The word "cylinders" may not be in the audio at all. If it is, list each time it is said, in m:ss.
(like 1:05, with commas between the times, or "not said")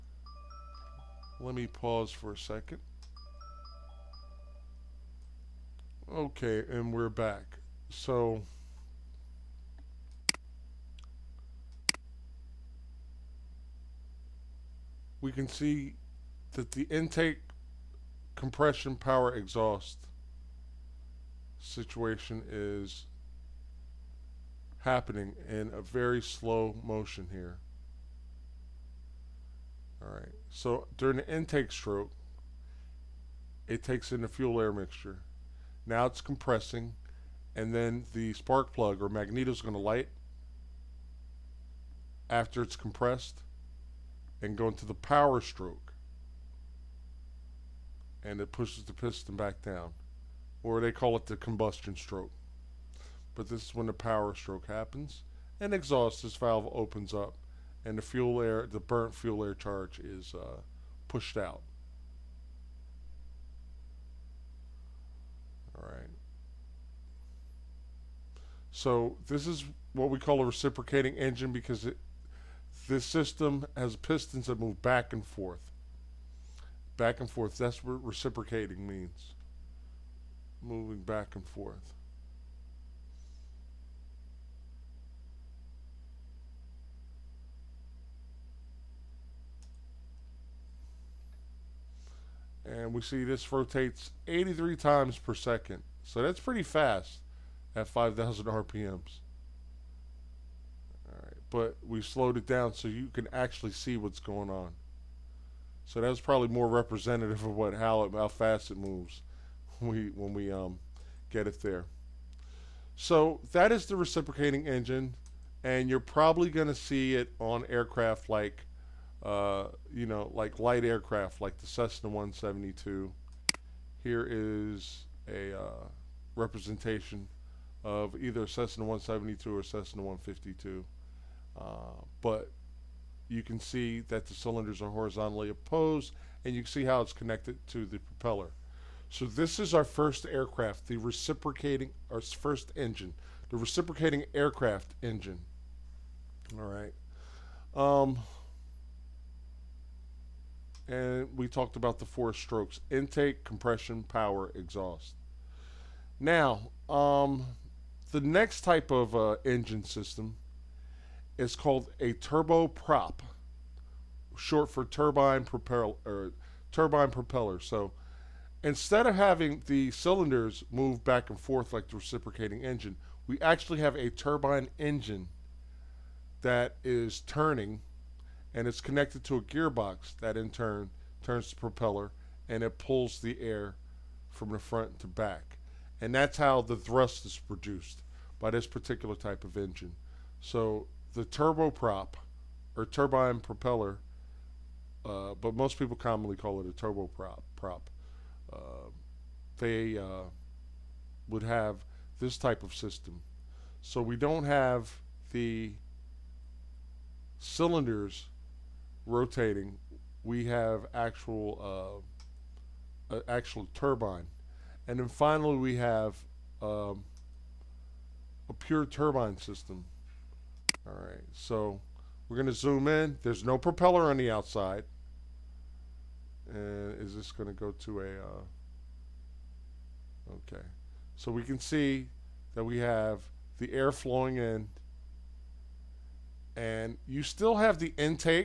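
2:14, 2:49, 3:27.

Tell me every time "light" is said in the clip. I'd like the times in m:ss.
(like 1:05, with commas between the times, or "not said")
0:39, 2:00.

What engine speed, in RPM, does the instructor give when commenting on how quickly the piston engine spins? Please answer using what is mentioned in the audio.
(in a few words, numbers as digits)
5,000.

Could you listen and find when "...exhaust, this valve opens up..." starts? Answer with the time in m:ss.
0:55.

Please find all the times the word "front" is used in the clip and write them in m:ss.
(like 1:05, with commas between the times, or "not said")
3:04.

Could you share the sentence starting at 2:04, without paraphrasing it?
Here is a uh, representation of either Cessna 172 or Cessna 152.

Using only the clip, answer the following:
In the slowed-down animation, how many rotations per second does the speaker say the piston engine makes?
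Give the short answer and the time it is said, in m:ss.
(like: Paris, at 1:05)
83, at 1:34.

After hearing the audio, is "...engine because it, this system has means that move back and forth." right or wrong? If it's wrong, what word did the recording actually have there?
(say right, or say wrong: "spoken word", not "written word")
wrong: "pistons", not "means".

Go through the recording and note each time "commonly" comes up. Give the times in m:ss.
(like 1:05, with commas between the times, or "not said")
3:15.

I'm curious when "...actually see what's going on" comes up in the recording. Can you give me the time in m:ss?
1:43.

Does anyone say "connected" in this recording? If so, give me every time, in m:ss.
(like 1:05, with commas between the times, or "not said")
2:17, 2:58.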